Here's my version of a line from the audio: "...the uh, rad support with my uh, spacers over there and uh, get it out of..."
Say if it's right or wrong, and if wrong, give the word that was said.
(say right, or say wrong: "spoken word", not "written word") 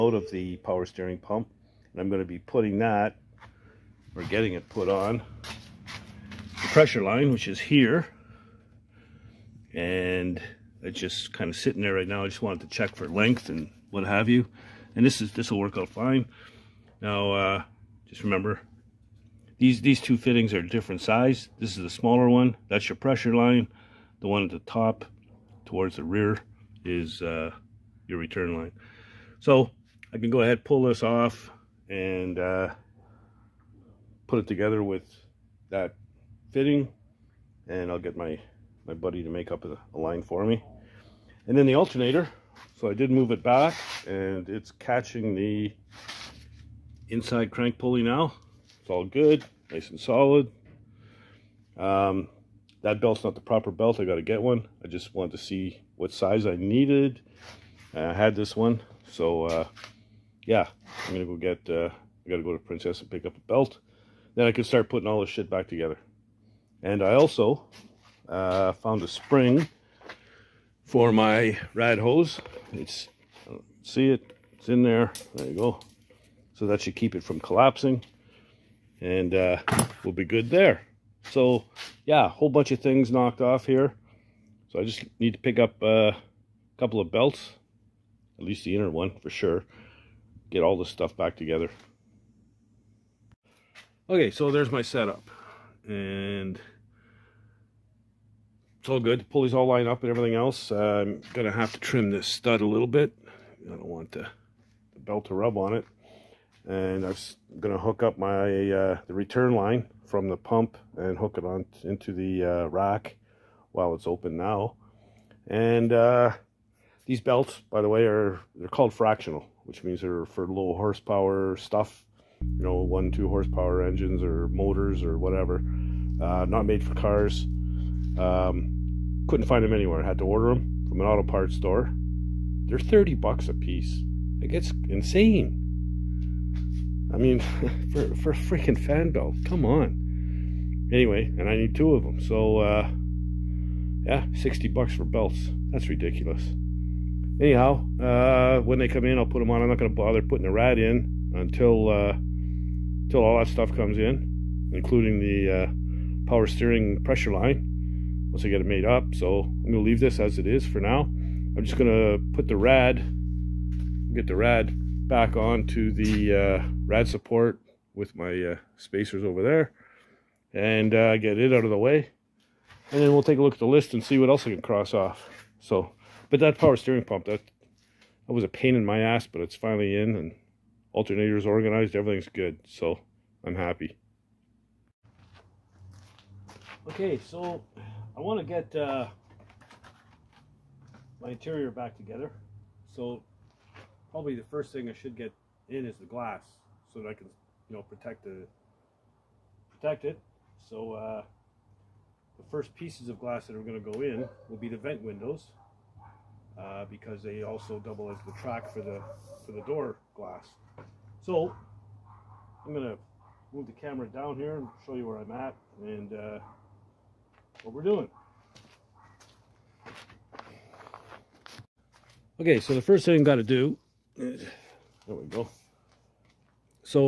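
right.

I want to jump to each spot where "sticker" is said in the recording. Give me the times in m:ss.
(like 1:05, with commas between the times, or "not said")
not said.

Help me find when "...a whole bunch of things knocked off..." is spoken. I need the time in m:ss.
1:22.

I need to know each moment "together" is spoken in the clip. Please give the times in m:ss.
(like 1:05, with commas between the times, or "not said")
0:34, 1:05, 1:31, 3:11.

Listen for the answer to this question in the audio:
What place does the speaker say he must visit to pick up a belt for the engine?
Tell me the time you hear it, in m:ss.
1:02.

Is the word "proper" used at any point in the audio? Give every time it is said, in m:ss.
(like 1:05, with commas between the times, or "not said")
0:53.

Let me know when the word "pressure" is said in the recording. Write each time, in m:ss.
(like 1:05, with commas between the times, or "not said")
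0:06, 0:22, 2:36.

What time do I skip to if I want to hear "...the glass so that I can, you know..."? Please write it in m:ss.
3:15.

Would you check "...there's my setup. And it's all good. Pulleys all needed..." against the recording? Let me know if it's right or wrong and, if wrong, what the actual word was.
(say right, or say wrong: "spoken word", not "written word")
wrong: "lined", not "needed".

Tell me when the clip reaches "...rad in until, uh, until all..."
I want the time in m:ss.
2:30.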